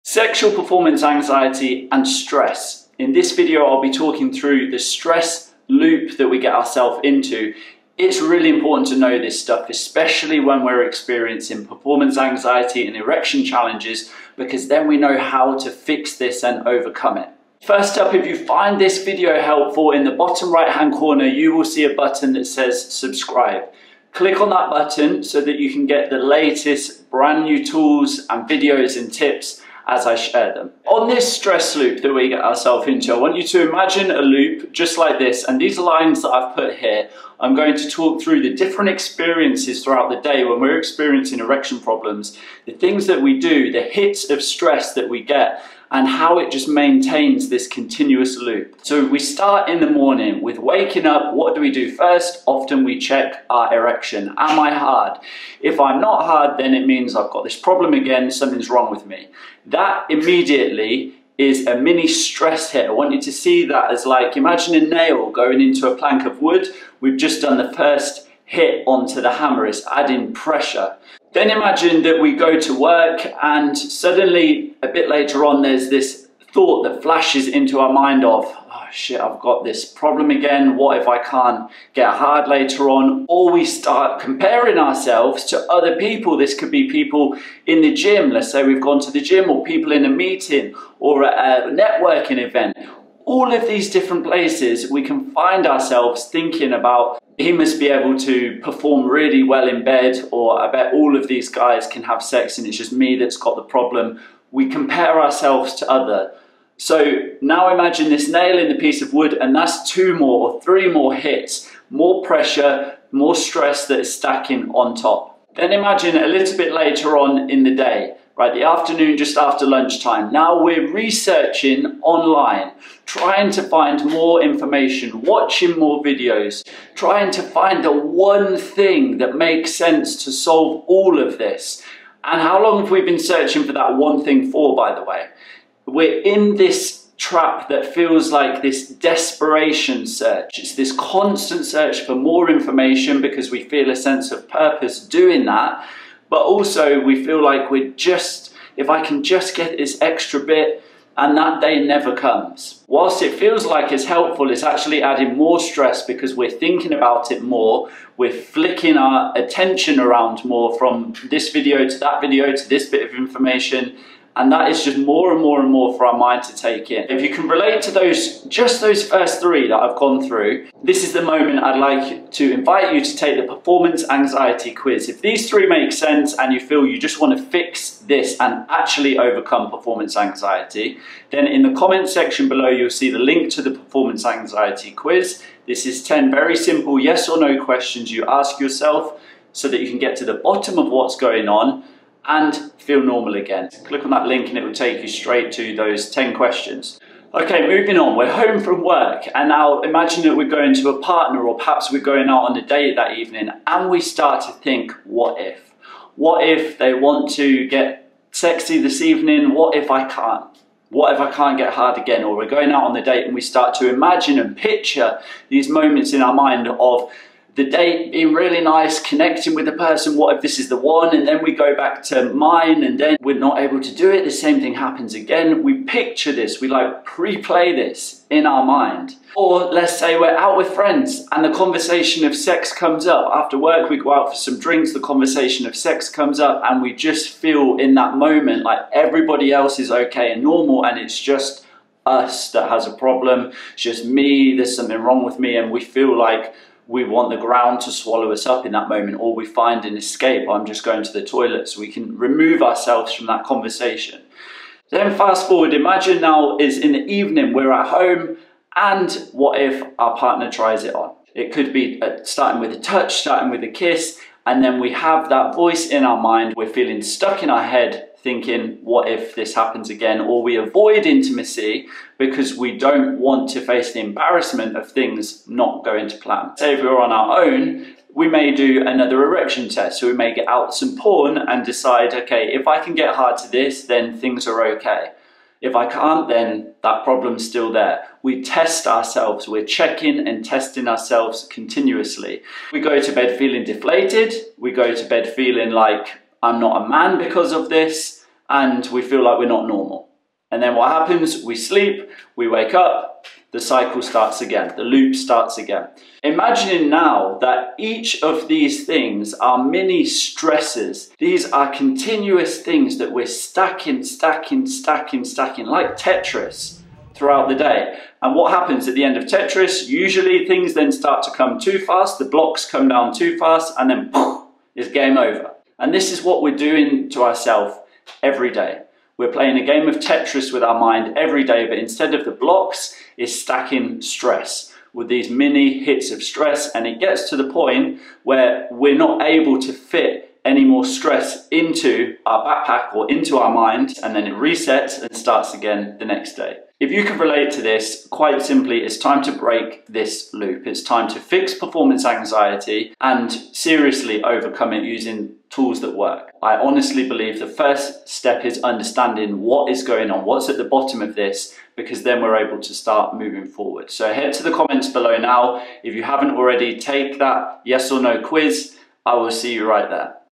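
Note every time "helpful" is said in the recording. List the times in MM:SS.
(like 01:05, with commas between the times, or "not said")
00:19, 02:34.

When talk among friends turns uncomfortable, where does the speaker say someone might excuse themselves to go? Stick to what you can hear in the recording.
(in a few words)
the toilet.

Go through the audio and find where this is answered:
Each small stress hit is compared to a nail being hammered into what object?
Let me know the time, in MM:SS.
01:05.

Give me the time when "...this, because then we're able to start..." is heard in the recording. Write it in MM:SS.
06:01.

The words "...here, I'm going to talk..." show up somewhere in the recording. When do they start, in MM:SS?
00:36.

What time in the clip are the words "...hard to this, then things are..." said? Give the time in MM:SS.
04:43.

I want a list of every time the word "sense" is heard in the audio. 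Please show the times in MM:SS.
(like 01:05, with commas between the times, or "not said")
02:09, 02:23, 02:55.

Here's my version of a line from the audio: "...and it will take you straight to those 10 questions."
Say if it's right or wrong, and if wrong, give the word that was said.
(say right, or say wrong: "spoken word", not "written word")
right.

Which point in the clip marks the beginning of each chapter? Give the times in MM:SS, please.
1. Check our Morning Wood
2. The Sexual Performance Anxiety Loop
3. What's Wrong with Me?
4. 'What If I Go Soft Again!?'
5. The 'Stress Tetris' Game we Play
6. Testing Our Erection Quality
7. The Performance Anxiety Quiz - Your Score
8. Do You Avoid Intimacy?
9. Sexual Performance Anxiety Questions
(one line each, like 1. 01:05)
1. 00:49
2. 00:30
3. 01:14
4. 03:20
5. 05:05
6. 04:38
7. 02:47
8. 04:15
9. 02:00.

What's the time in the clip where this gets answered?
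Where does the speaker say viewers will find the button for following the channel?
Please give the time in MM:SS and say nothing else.
00:20.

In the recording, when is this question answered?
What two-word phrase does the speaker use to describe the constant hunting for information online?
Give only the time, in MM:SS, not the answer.
02:18.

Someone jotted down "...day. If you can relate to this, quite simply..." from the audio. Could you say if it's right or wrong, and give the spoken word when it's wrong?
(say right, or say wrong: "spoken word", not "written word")
right.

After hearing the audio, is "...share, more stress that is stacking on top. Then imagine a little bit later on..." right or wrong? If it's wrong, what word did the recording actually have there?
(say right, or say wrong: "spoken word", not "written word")
wrong: "pressure", not "share".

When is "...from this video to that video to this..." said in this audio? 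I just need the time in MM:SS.
02:40.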